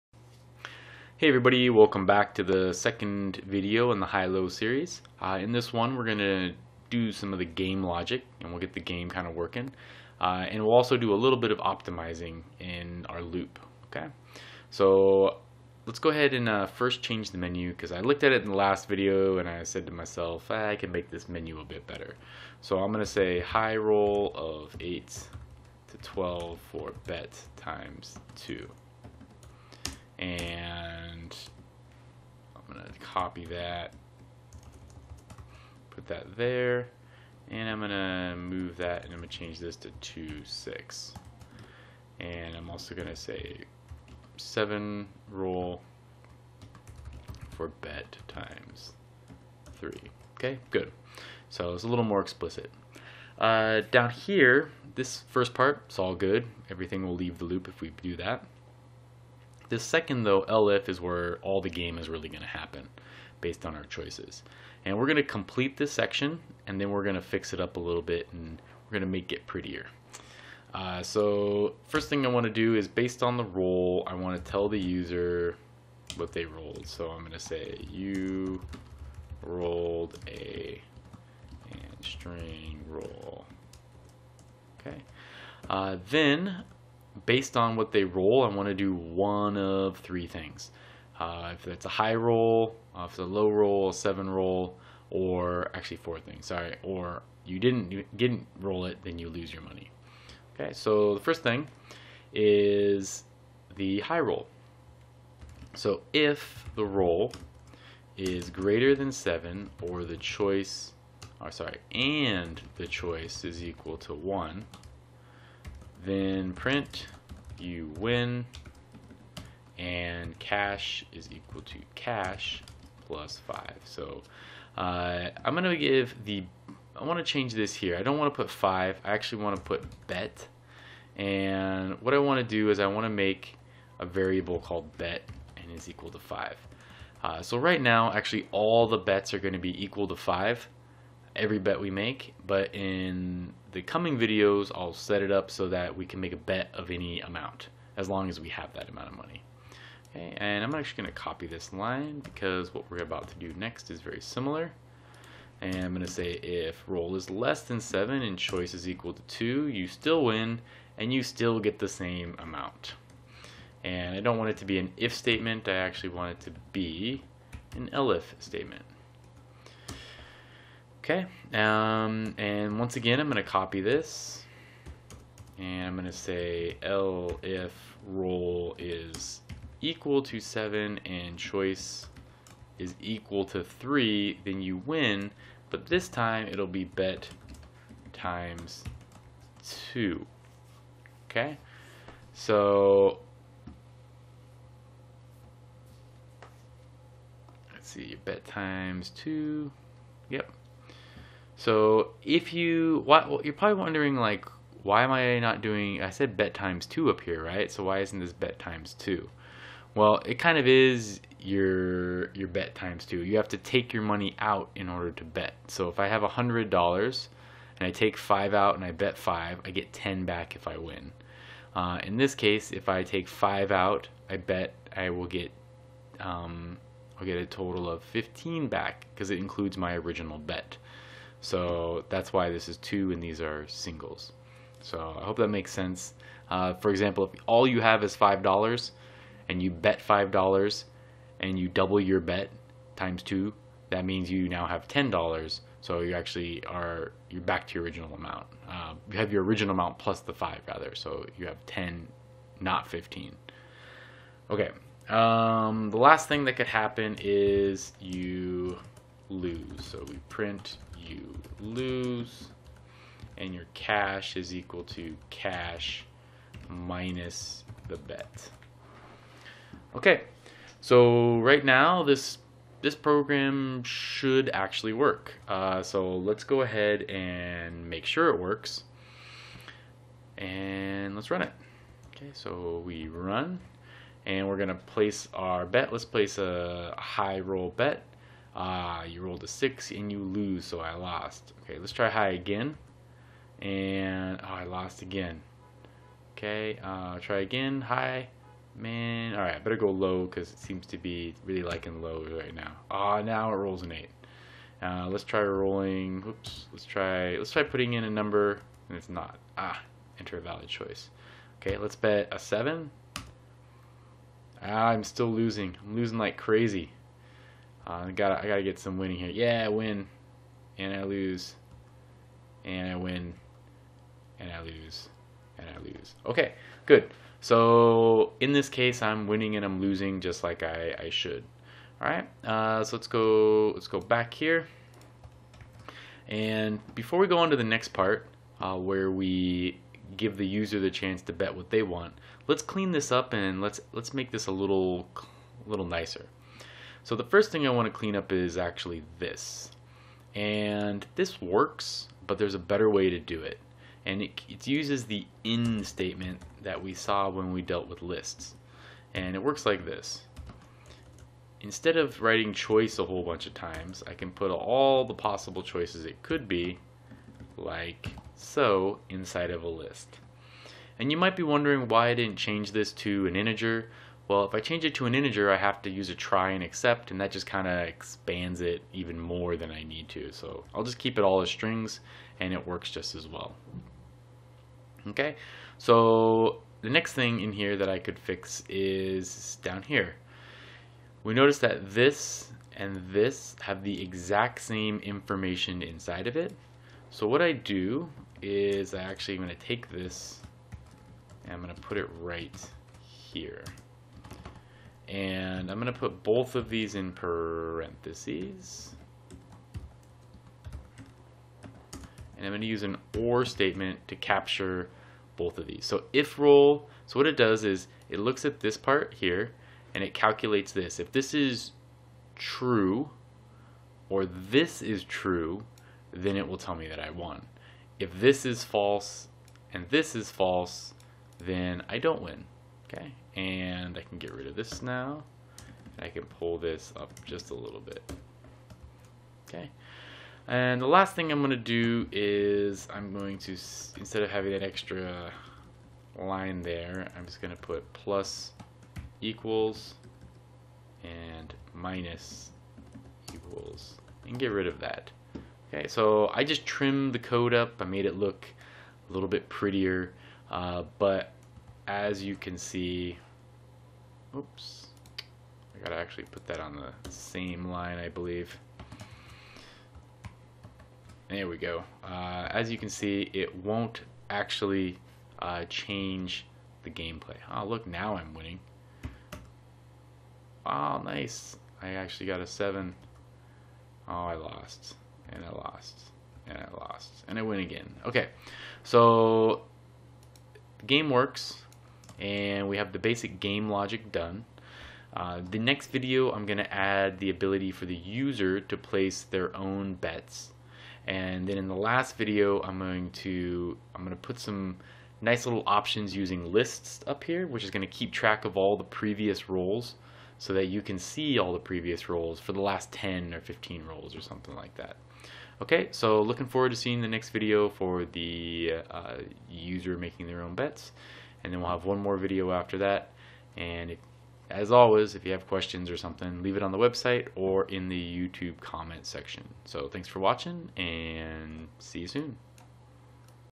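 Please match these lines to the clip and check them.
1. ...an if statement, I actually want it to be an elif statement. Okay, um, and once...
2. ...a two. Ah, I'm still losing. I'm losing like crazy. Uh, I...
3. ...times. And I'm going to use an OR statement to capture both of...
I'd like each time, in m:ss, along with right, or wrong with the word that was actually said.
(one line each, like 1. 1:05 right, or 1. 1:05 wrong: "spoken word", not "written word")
1. 2:44 right
2. 5:12 wrong: "seven", not "two"
3. 6:47 wrong: "parentheses", not "times".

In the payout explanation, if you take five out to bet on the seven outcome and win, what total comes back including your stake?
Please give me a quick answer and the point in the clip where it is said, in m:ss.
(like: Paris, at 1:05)
15, at 3:48.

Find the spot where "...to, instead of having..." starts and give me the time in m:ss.
7:23.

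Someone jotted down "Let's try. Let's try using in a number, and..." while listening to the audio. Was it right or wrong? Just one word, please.
wrong.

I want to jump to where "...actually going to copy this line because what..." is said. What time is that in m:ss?
2:30.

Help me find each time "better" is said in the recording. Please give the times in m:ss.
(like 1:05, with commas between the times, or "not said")
0:21, 4:59, 5:52.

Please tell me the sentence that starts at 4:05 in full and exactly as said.
So you actually are, you're back to your original amount.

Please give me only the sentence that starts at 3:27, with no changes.
So why isn't this bet times two?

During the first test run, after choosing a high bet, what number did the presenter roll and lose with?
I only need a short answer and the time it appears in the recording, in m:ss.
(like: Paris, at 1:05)
6, at 4:49.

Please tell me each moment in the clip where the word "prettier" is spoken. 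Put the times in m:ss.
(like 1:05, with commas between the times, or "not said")
1:09, 7:39.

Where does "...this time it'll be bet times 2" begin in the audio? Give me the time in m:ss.
3:05.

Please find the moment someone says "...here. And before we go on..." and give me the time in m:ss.
5:34.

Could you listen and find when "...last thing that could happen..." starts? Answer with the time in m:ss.
4:15.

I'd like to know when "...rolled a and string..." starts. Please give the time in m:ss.
1:19.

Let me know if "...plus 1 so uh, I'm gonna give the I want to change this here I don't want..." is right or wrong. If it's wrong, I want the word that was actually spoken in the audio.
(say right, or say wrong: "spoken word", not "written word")
wrong: "5", not "1".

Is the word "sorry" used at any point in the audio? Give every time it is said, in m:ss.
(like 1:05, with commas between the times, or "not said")
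1:36, 1:51.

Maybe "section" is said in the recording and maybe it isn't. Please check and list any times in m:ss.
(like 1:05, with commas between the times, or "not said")
1:05, 8:49.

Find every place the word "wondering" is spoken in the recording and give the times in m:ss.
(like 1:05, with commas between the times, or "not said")
3:23, 6:11.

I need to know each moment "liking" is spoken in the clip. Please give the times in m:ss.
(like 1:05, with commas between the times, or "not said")
5:01.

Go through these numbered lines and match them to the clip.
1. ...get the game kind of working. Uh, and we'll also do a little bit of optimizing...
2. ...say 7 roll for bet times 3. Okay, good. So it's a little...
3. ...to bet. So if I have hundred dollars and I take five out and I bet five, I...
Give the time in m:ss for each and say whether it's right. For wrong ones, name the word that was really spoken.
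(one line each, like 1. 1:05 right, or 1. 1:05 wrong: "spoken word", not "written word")
1. 0:08 right
2. 0:43 right
3. 3:35 right.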